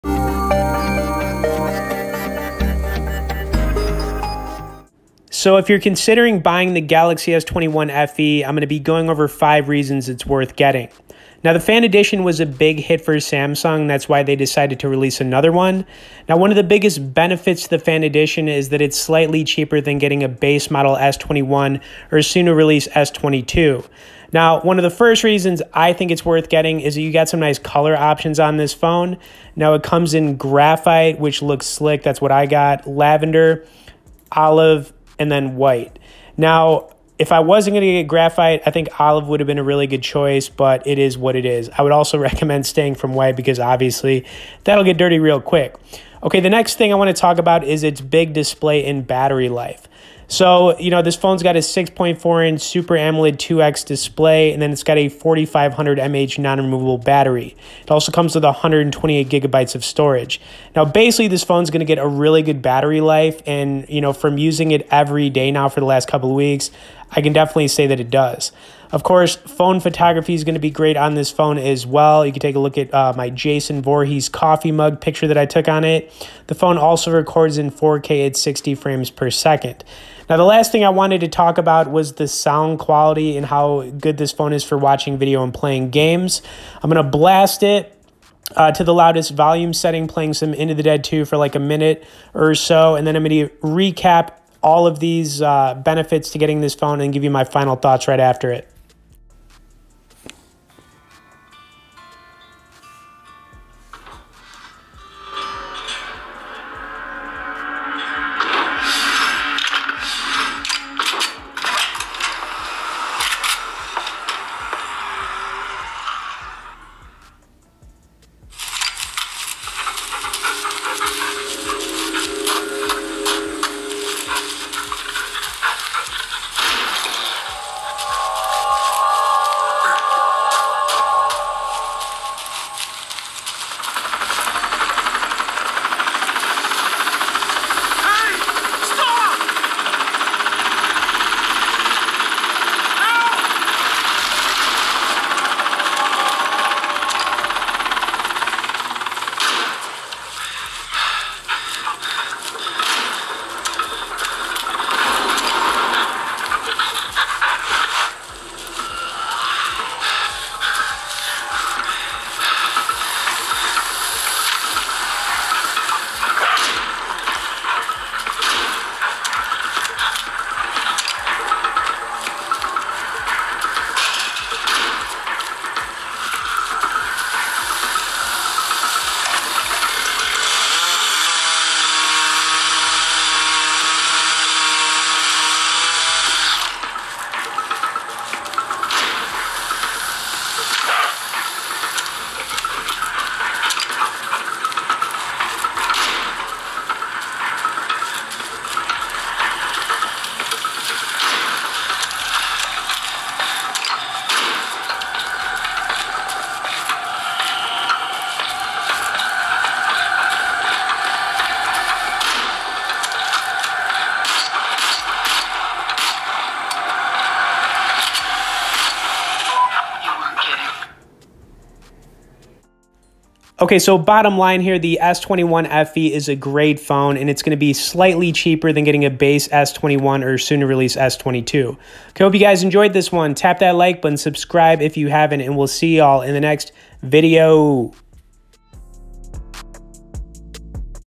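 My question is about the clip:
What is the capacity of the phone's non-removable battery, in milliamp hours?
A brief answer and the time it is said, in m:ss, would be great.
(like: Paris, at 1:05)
4500 mAh, at 0:55.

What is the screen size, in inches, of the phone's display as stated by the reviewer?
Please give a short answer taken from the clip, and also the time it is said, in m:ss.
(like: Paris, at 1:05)
6.4 inches, at 0:51.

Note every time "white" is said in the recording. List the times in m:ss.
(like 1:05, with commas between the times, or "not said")
0:35, 0:43.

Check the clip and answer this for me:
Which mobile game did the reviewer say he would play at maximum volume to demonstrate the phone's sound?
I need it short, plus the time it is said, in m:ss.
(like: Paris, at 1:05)
Into the Dead 2, at 1:30.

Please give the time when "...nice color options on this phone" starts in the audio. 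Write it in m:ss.
0:27.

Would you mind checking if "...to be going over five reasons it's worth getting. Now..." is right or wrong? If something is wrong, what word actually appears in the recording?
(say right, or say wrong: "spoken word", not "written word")
right.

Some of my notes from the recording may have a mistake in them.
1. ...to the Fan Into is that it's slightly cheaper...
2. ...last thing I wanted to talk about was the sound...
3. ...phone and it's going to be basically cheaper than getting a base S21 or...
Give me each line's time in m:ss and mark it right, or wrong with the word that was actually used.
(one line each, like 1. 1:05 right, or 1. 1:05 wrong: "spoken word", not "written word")
1. 0:17 wrong: "Edition", not "Into"
2. 1:20 right
3. 3:46 wrong: "slightly", not "basically".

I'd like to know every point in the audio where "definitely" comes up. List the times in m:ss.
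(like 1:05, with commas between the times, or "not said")
1:07.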